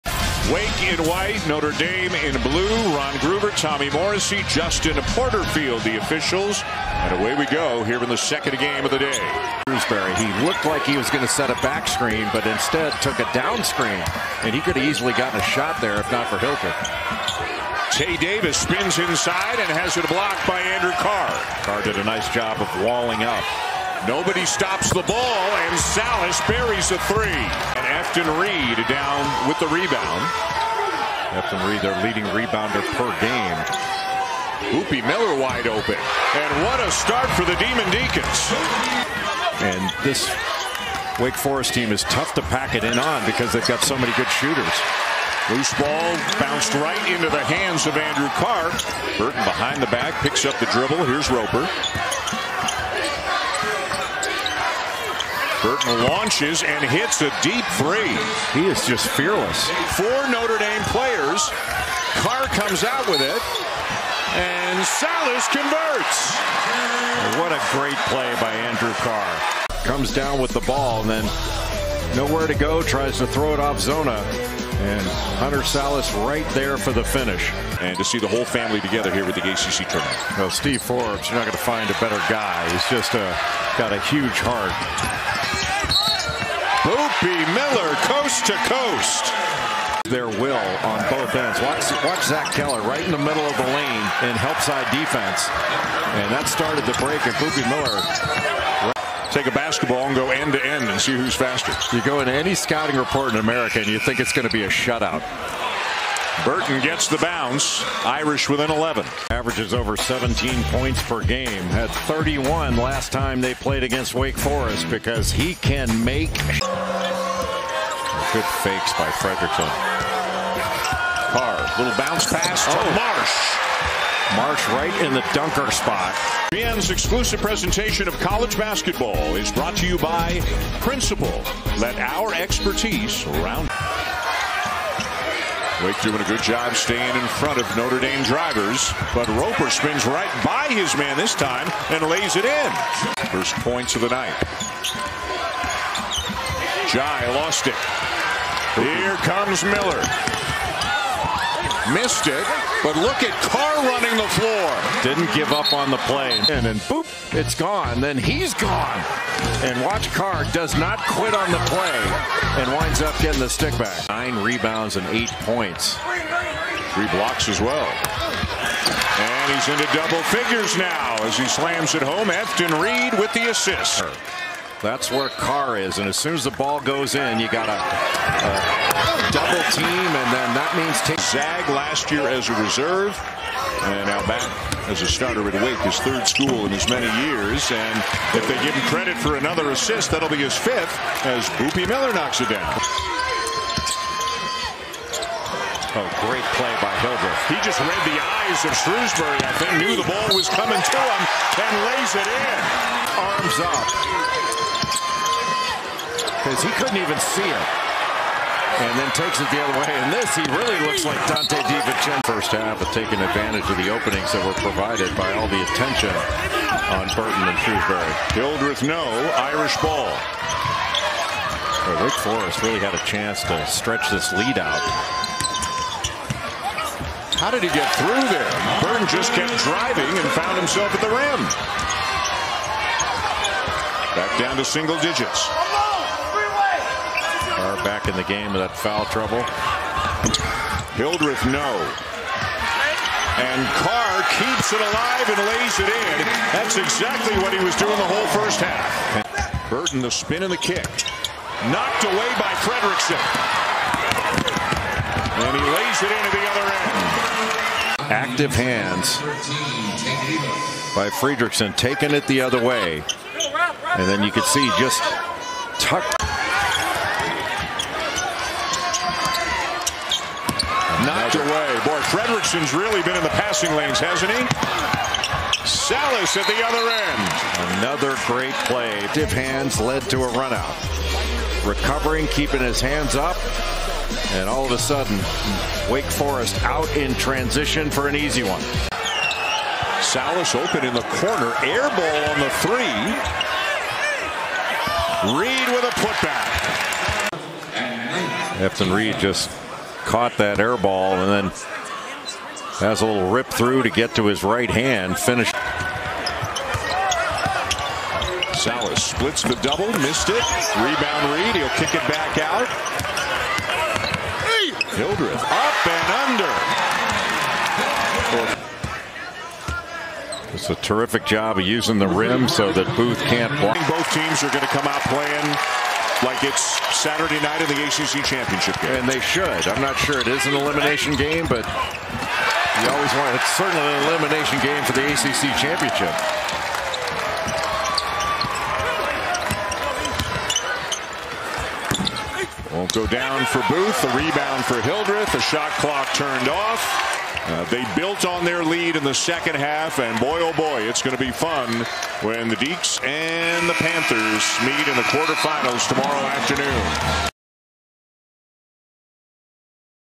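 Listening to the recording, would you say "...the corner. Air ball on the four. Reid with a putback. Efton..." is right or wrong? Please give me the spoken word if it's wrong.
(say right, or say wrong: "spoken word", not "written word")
wrong: "three", not "four".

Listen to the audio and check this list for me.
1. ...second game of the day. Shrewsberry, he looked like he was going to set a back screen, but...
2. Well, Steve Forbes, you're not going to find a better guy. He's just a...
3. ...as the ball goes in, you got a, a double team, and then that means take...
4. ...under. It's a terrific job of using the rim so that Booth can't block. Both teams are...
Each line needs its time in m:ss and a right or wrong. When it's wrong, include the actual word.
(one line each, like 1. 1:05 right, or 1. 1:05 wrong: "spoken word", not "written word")
1. 0:08 right
2. 1:20 right
3. 2:56 right
4. 5:16 right.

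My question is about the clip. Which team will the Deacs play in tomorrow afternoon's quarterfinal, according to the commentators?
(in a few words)
Panthers.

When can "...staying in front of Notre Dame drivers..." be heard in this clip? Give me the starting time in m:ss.
2:16.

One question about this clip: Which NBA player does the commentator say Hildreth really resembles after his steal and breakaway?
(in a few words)
Donte DiVincenzo.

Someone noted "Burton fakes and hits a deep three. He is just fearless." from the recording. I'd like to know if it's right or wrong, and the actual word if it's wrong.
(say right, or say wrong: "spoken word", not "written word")
wrong: "launches", not "fakes".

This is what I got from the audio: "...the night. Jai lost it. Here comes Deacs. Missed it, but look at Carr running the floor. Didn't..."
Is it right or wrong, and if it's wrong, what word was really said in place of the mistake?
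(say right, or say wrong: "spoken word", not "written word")
wrong: "Miller", not "Deacs".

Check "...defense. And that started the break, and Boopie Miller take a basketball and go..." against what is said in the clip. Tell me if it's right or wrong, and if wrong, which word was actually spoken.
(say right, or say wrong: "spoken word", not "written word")
right.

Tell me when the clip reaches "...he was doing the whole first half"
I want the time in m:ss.
4:07.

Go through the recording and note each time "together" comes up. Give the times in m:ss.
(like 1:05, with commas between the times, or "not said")
1:18.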